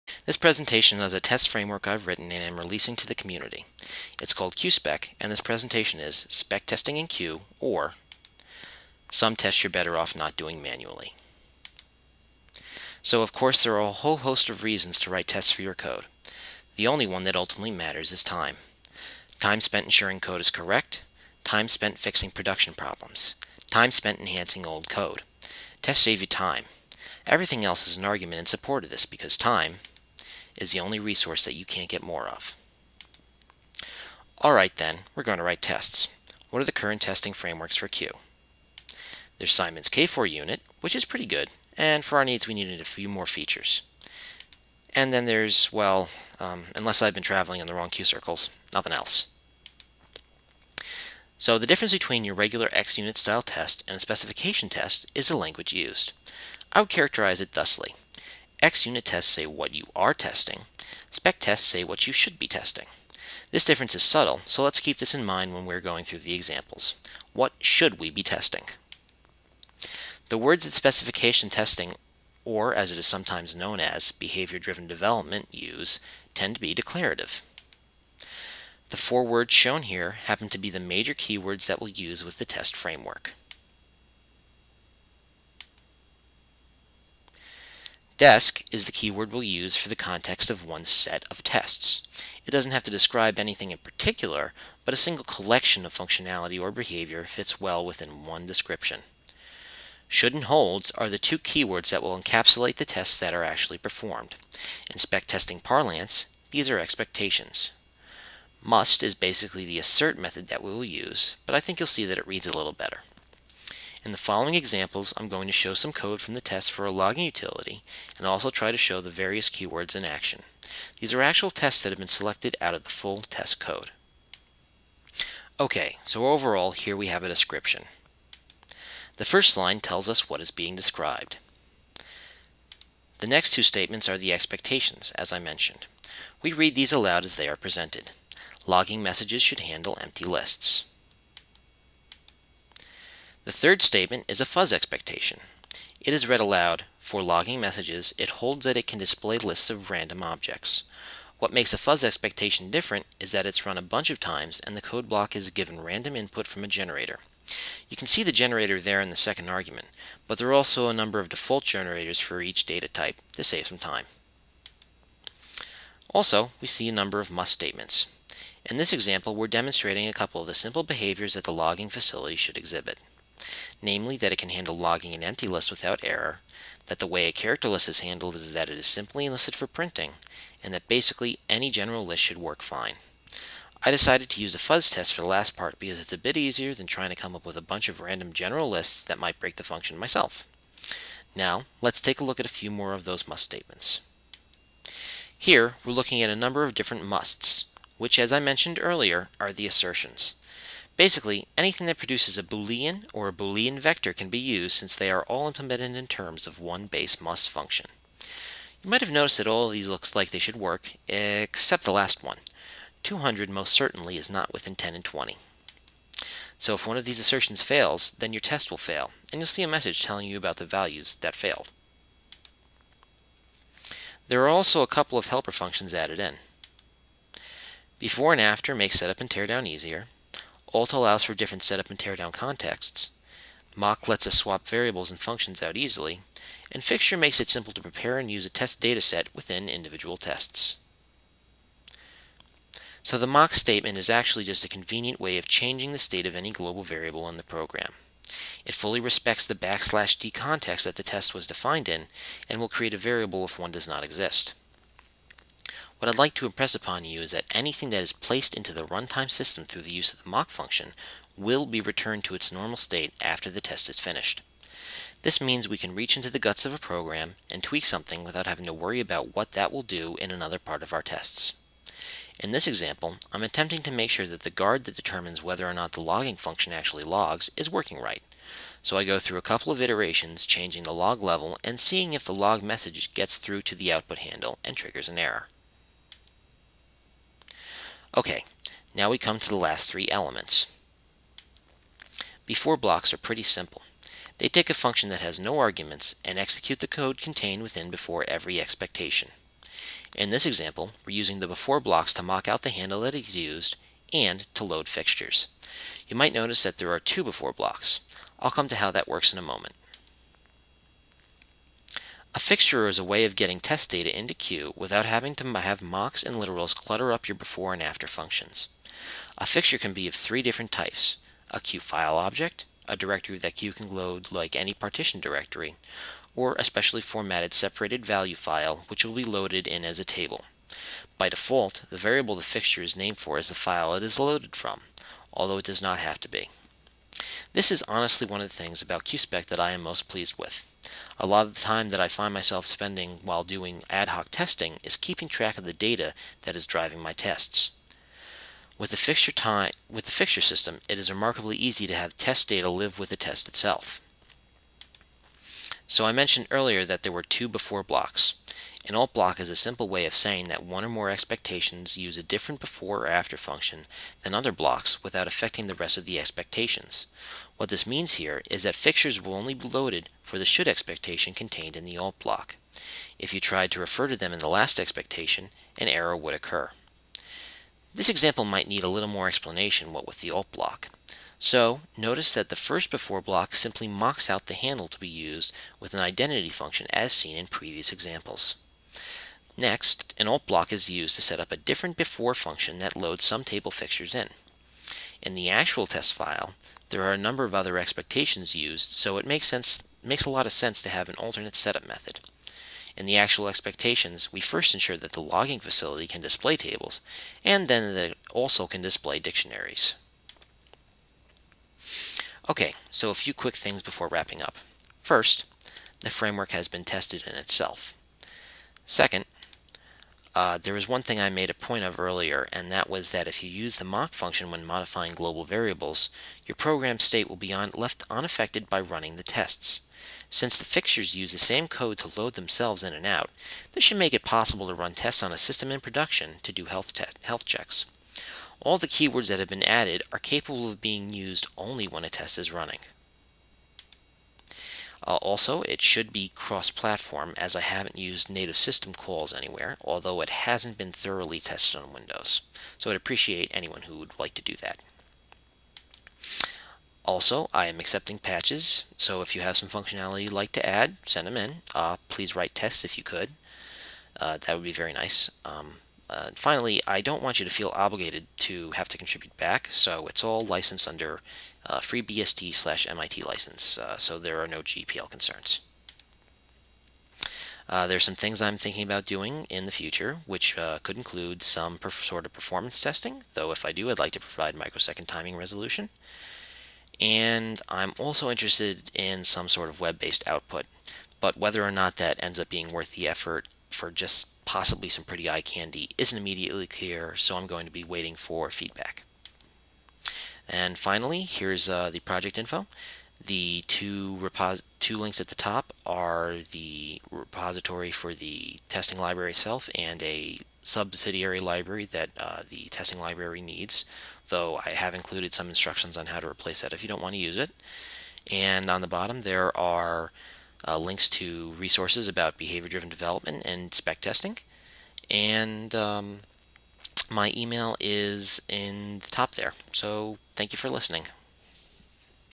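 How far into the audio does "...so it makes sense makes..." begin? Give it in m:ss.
6:38.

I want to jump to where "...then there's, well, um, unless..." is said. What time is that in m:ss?
0:45.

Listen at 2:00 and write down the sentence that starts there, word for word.
These are actual tests that have been selected out of the full test code.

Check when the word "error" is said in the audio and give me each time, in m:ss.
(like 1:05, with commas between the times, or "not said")
2:56, 4:45, 6:15.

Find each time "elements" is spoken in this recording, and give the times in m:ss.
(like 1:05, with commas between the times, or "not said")
4:50.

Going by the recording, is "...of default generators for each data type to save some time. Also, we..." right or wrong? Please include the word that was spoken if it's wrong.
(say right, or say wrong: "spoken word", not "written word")
right.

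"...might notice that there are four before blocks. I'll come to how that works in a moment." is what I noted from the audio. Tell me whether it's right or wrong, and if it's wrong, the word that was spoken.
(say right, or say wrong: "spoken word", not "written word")
wrong: "two", not "four".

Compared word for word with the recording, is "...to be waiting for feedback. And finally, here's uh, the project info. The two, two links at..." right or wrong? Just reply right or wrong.
right.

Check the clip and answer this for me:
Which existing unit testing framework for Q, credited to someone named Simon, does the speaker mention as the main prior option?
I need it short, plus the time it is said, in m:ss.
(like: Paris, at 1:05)
K4 unit, at 0:39.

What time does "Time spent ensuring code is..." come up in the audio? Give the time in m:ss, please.
0:19.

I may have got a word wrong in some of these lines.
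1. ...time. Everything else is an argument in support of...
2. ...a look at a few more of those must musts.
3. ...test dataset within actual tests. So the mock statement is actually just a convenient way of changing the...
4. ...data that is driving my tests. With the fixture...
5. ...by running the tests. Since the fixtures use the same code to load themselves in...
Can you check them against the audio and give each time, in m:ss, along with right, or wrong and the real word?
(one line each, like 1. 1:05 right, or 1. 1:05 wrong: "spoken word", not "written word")
1. 0:26 right
2. 3:12 wrong: "statements", not "musts"
3. 3:58 wrong: "individual", not "actual"
4. 5:45 right
5. 7:08 right.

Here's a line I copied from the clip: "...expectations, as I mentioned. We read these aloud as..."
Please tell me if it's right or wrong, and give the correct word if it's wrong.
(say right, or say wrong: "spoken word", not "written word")
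right.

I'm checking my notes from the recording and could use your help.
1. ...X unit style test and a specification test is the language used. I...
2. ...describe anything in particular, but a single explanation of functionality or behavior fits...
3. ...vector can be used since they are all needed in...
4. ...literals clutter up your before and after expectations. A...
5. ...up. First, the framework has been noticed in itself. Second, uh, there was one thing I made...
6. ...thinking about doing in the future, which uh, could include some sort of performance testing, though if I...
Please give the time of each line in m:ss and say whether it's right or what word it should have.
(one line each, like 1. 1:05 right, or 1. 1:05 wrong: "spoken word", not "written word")
1. 0:52 right
2. 1:32 wrong: "collection", not "explanation"
3. 3:23 wrong: "implemented", not "needed"
4. 5:16 wrong: "functions", not "expectations"
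5. 6:54 wrong: "tested", not "noticed"
6. 7:58 right.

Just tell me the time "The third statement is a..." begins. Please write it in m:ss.
2:23.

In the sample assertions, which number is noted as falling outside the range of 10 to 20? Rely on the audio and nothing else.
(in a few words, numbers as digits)
200.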